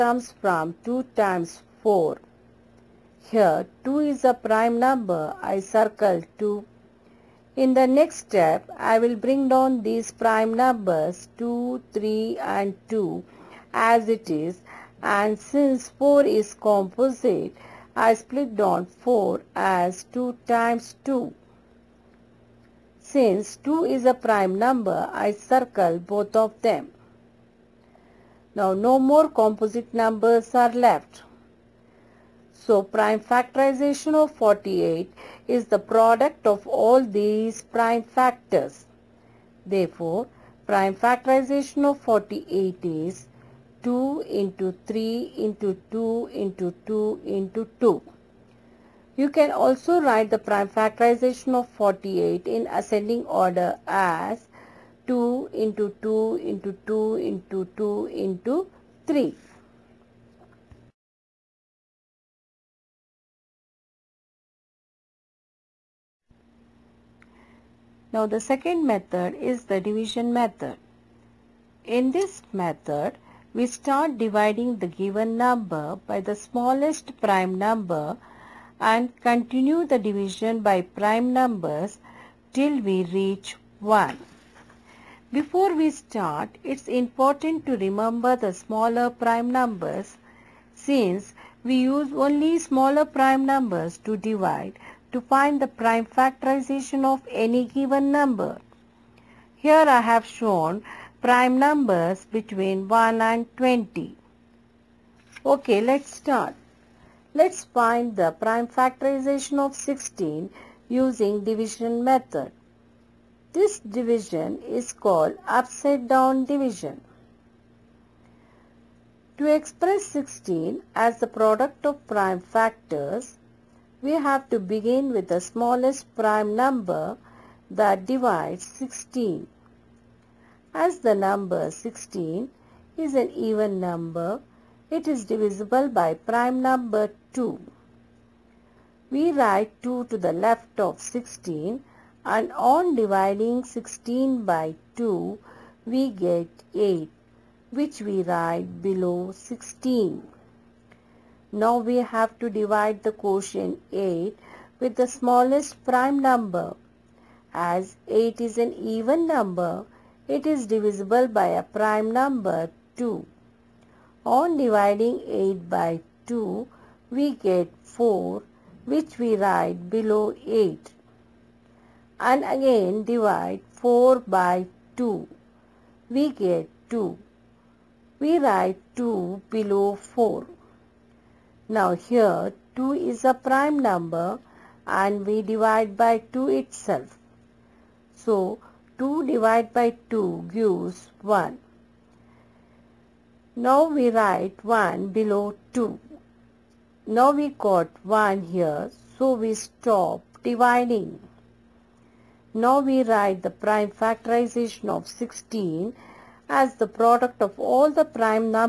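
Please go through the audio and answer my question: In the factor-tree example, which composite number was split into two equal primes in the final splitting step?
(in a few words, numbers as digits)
4.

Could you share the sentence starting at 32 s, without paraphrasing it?
So prime factorization of 48 is the product of all these prime factors.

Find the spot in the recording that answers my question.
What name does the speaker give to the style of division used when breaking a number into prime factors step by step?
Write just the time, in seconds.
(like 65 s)
115 s.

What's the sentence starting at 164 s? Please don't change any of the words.
On dividing 8 by 2, we get 4 which we write below 8 and again divide 4 by 2.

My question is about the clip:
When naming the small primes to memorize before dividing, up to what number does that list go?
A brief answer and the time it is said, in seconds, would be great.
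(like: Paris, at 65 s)
20, at 102 s.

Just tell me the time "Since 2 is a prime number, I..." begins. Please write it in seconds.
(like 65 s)
23 s.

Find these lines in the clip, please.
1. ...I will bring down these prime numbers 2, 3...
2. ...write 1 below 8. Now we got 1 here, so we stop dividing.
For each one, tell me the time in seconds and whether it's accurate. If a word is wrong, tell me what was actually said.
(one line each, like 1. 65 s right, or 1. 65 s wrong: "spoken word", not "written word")
1. 8 s right
2. 194 s wrong: "2", not "8".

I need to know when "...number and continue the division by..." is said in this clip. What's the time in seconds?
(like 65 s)
77 s.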